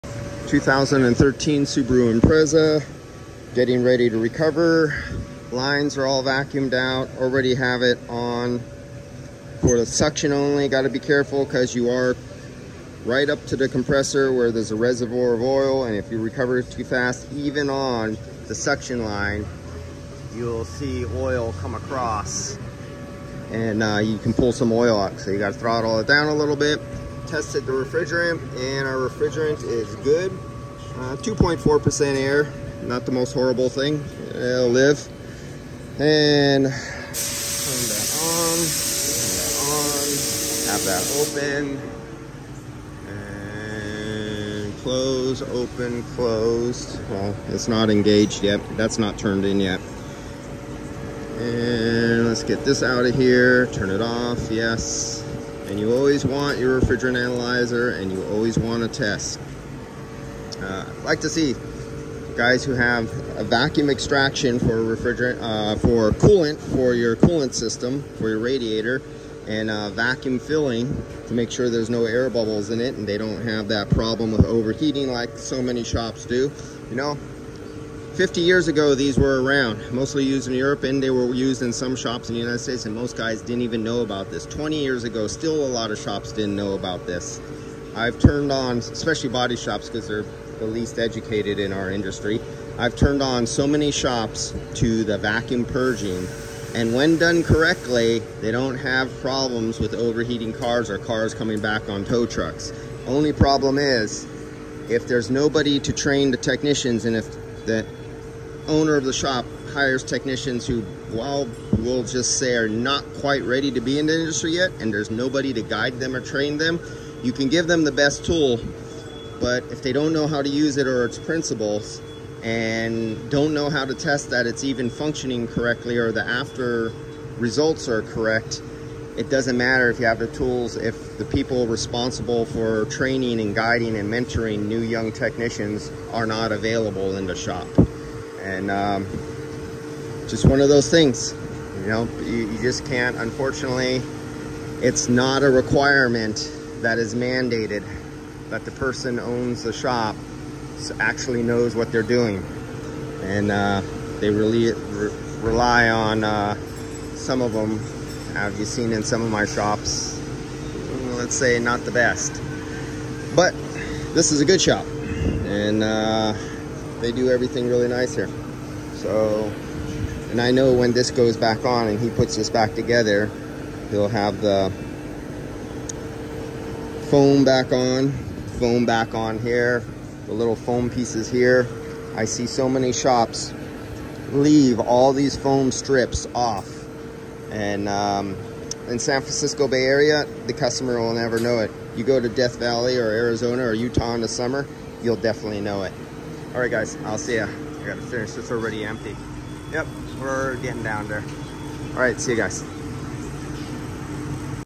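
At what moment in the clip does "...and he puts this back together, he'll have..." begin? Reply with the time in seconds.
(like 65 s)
171 s.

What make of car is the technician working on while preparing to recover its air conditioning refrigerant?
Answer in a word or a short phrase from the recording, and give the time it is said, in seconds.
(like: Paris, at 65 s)
Subaru Impreza, at 1 s.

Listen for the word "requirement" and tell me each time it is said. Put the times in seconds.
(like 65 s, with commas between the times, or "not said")
145 s.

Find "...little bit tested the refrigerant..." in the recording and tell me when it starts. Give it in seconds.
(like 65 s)
26 s.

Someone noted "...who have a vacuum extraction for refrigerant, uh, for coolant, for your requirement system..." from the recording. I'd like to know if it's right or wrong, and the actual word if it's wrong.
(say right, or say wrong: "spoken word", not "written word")
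wrong: "coolant", not "requirement".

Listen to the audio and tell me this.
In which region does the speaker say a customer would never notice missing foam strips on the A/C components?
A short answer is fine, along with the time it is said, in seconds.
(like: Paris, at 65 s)
San Francisco Bay Area, at 188 s.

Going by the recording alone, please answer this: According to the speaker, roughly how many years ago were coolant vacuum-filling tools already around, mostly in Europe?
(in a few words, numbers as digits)
50 years.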